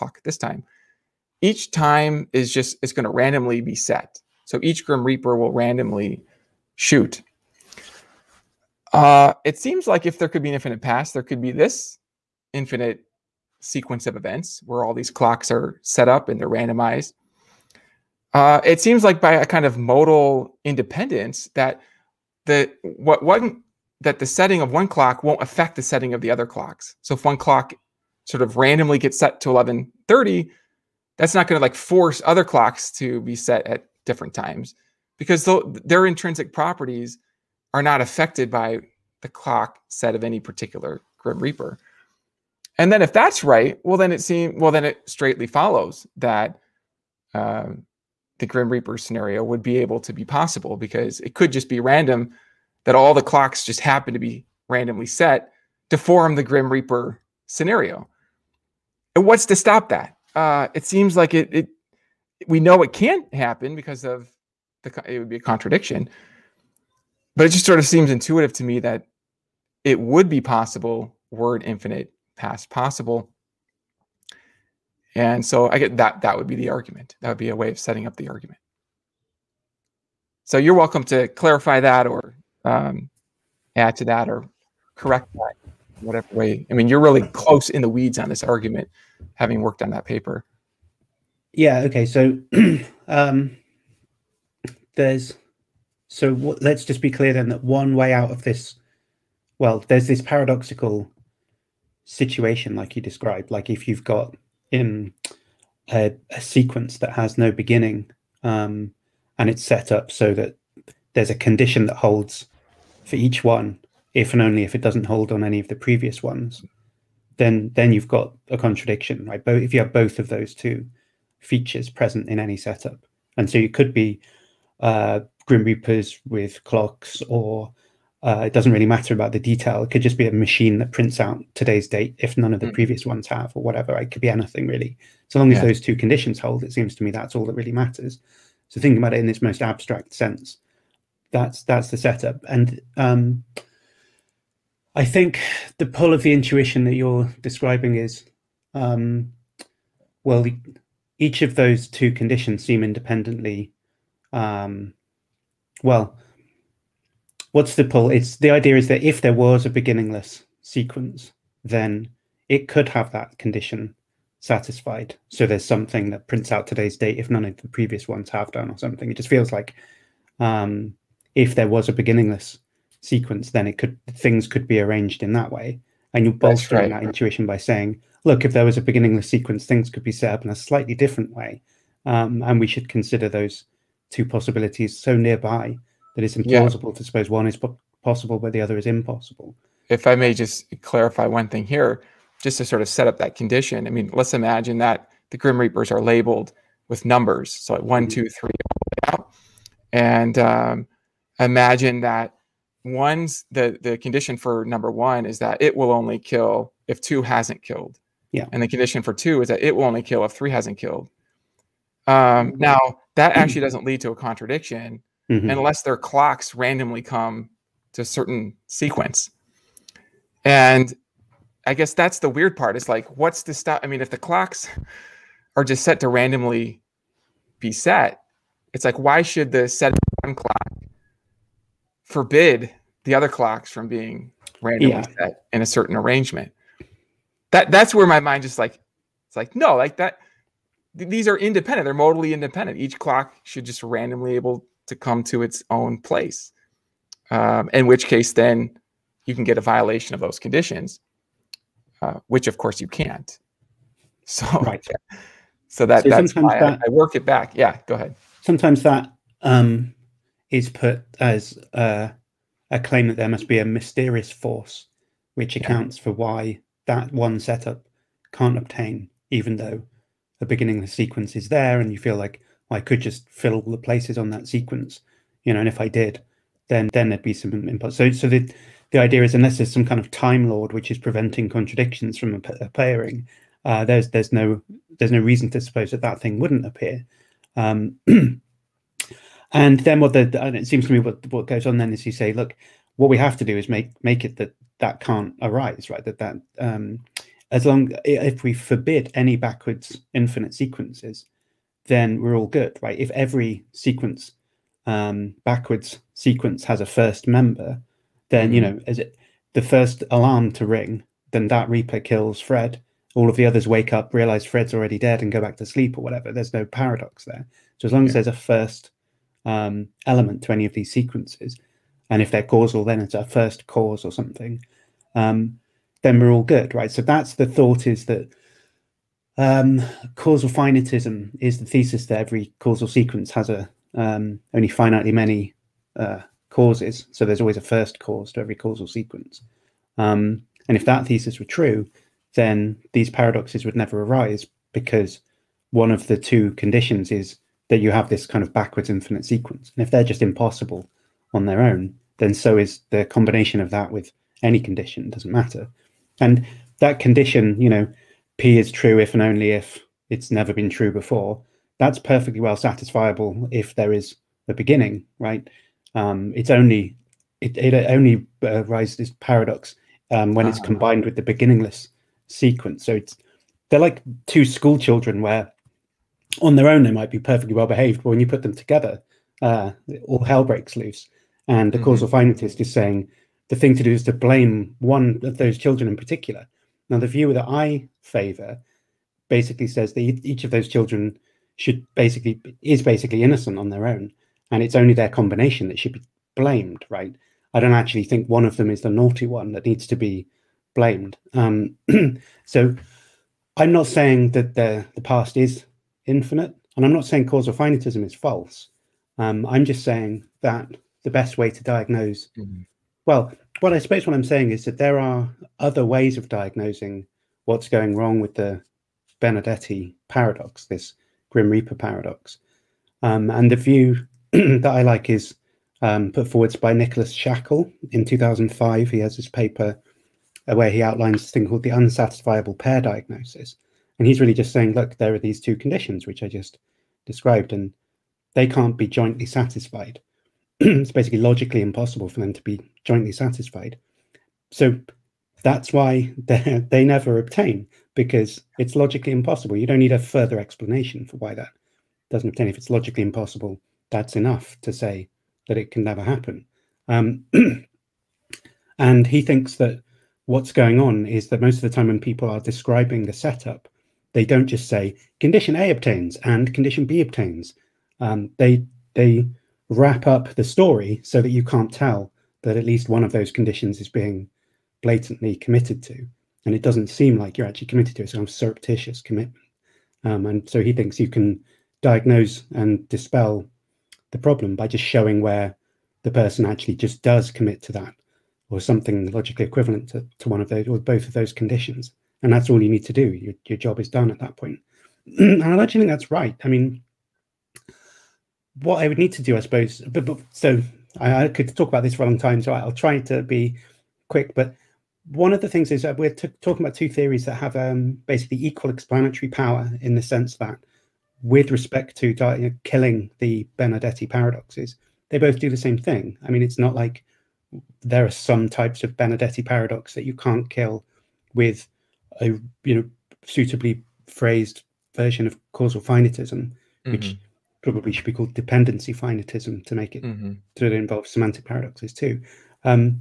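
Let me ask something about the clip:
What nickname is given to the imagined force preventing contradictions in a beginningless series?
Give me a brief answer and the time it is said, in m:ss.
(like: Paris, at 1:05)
Time lord, at 4:40.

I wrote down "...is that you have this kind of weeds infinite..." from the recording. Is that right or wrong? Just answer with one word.
wrong.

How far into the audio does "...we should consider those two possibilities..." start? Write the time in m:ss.
3:02.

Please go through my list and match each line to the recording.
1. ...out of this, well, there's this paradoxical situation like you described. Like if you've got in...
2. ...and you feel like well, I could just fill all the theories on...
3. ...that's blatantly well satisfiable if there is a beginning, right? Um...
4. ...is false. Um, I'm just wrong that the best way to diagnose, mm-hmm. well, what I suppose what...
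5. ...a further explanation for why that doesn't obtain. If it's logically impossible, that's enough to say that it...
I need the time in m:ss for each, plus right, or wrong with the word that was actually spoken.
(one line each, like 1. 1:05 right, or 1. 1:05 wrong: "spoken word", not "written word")
1. 1:38 right
2. 4:31 wrong: "places", not "theories"
3. 6:01 wrong: "perfectly", not "blatantly"
4. 6:48 wrong: "saying", not "wrong"
5. 7:29 right.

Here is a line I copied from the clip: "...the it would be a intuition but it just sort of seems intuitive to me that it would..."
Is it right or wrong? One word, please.
wrong.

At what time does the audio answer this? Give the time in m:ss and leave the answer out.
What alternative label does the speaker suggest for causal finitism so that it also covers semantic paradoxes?
8:48.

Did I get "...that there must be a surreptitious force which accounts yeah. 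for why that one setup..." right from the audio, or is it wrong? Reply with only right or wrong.
wrong.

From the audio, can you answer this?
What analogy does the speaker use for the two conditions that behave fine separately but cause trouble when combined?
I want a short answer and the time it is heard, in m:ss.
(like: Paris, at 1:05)
Two school children, at 6:14.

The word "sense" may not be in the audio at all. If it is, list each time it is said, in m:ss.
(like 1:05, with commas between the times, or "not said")
2:20, 8:30.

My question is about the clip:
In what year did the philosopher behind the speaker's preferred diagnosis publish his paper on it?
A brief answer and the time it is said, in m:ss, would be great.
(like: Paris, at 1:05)
2005, at 7:08.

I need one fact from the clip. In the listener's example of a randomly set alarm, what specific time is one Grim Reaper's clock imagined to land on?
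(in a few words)
11:30.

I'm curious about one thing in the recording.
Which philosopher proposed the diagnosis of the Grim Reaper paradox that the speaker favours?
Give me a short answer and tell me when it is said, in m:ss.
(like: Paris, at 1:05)
Nicholas Shackle, at 7:06.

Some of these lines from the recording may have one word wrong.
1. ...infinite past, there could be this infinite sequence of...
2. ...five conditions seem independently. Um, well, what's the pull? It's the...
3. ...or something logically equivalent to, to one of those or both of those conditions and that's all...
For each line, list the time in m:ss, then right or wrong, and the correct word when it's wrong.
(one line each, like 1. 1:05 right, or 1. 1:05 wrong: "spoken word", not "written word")
1. 0:10 right
2. 2:31 wrong: "two", not "five"
3. 8:08 right.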